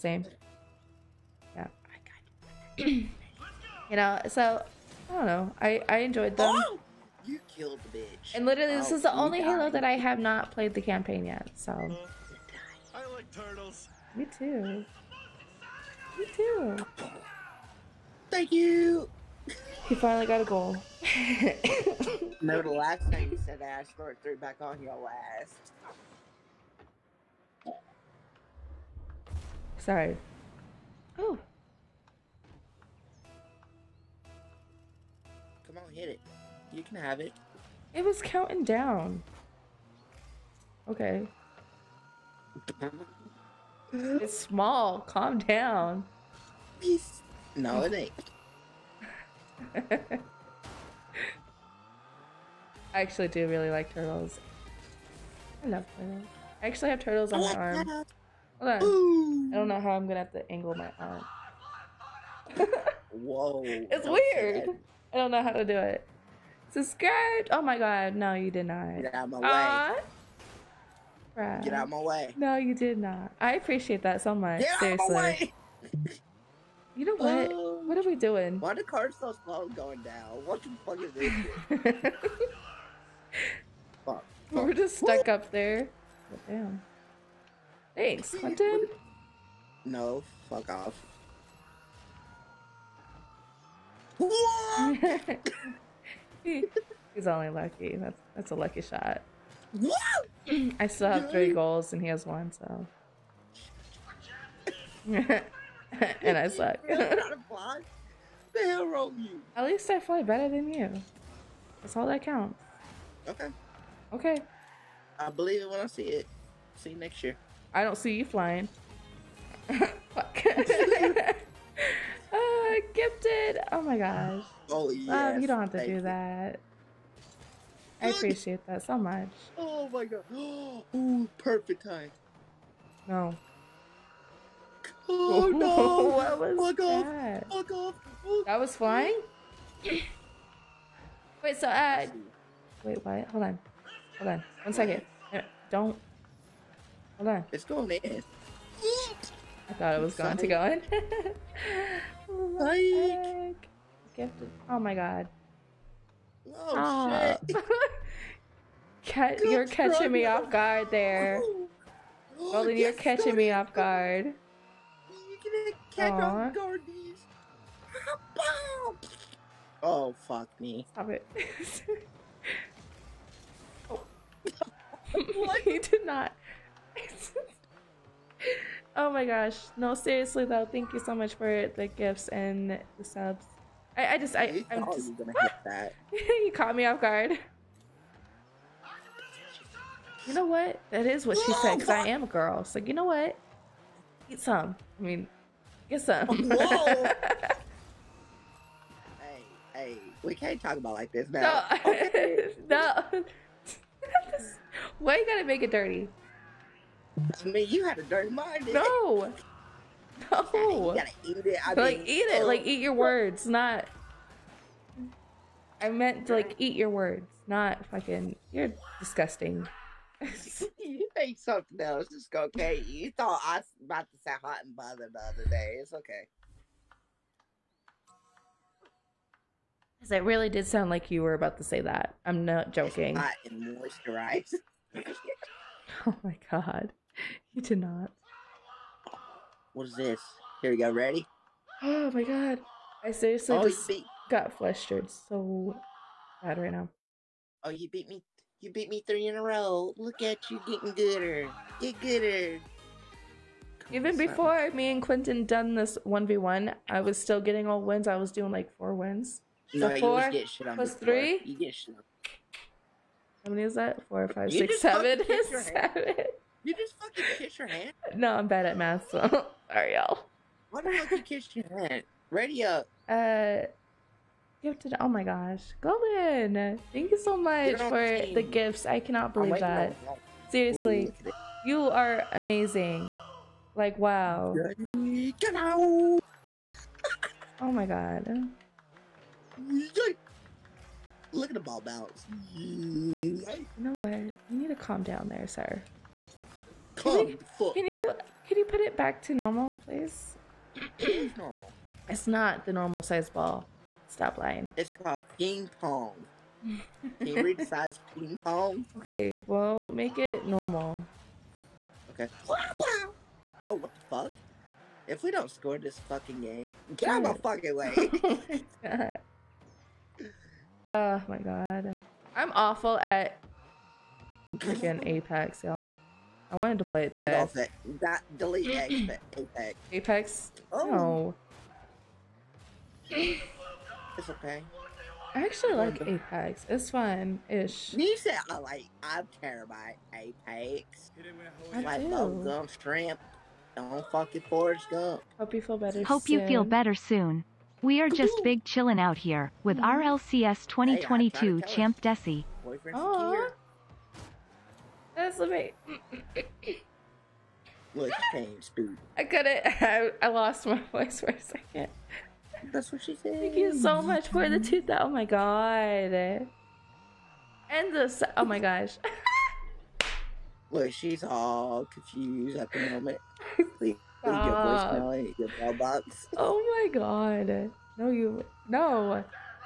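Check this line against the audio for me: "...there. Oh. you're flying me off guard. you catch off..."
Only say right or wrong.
wrong.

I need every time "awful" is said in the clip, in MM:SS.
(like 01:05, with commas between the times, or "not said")
05:22.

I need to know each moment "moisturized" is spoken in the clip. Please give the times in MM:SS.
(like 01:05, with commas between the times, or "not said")
03:53.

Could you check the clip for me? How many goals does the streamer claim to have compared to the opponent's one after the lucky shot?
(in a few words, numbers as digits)
3.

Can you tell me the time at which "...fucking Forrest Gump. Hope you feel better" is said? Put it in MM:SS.
05:44.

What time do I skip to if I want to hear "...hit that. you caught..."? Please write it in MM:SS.
03:05.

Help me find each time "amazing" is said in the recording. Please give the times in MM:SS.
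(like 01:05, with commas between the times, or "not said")
04:42, 05:55.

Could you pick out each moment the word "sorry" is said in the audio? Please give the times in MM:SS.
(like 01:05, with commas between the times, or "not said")
00:29, 04:29.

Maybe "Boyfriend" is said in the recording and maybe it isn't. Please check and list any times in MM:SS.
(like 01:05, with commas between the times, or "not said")
05:52.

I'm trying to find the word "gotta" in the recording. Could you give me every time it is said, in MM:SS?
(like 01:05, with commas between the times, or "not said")
03:25, 03:30.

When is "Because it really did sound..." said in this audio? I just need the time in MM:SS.
03:49.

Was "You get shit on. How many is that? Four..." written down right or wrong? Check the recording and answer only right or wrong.
right.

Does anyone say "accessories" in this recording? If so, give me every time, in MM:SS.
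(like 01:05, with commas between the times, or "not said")
not said.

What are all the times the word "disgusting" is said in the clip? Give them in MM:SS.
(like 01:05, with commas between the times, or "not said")
03:38.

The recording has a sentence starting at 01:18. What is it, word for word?
Why the car's so slow going down?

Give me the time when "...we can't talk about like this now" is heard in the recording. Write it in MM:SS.
03:20.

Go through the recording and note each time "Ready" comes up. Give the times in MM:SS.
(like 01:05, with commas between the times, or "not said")
04:00, 04:32.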